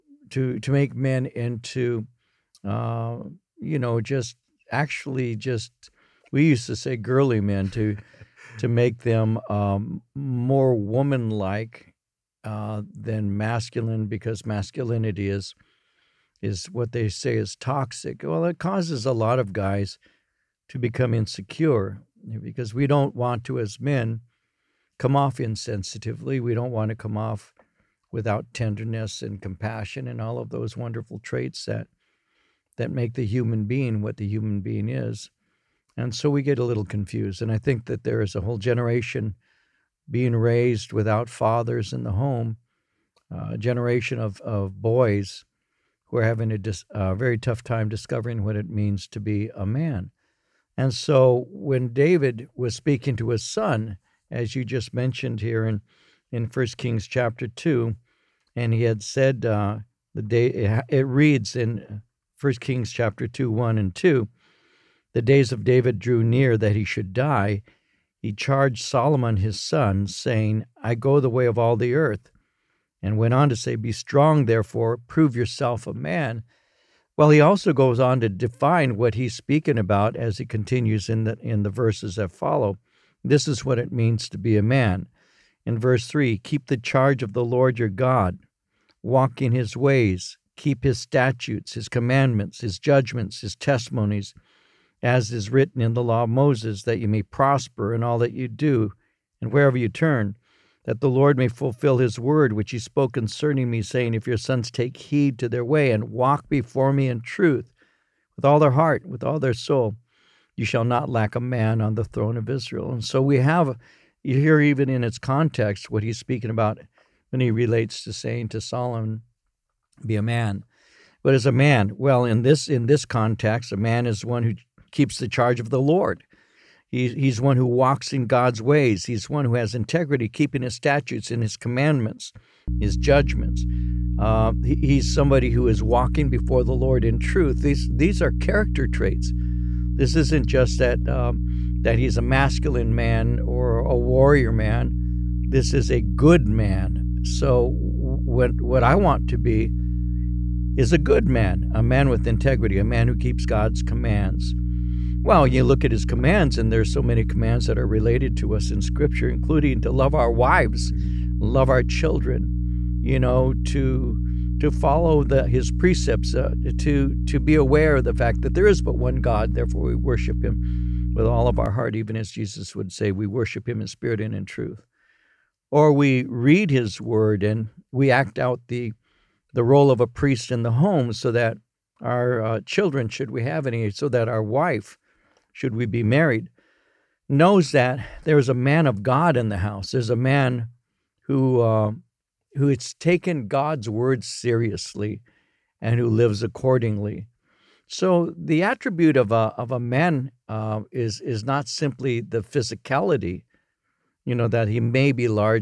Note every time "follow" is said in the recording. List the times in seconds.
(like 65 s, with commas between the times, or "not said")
82 s, 164 s.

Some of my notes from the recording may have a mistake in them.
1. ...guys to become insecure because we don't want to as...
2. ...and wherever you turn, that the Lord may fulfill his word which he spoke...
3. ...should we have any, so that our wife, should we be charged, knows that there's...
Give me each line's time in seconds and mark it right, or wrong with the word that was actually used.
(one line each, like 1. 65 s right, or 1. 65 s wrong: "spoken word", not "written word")
1. 19 s right
2. 99 s right
3. 183 s wrong: "married", not "charged".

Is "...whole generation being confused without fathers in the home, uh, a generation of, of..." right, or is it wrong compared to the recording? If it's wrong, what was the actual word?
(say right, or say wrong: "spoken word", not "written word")
wrong: "raised", not "confused".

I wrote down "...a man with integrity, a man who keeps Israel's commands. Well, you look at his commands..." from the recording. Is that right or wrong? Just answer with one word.
wrong.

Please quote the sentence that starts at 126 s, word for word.
He's, he's one who walks in God's ways.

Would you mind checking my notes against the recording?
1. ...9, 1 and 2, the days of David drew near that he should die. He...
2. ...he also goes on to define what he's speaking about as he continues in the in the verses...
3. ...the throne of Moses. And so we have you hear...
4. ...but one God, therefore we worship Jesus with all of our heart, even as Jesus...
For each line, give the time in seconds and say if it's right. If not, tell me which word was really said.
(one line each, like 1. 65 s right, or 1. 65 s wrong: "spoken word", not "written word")
1. 63 s wrong: "2", not "9"
2. 77 s right
3. 111 s wrong: "Israel", not "Moses"
4. 168 s wrong: "Him", not "Jesus".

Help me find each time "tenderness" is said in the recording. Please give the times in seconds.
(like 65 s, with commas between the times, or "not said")
28 s.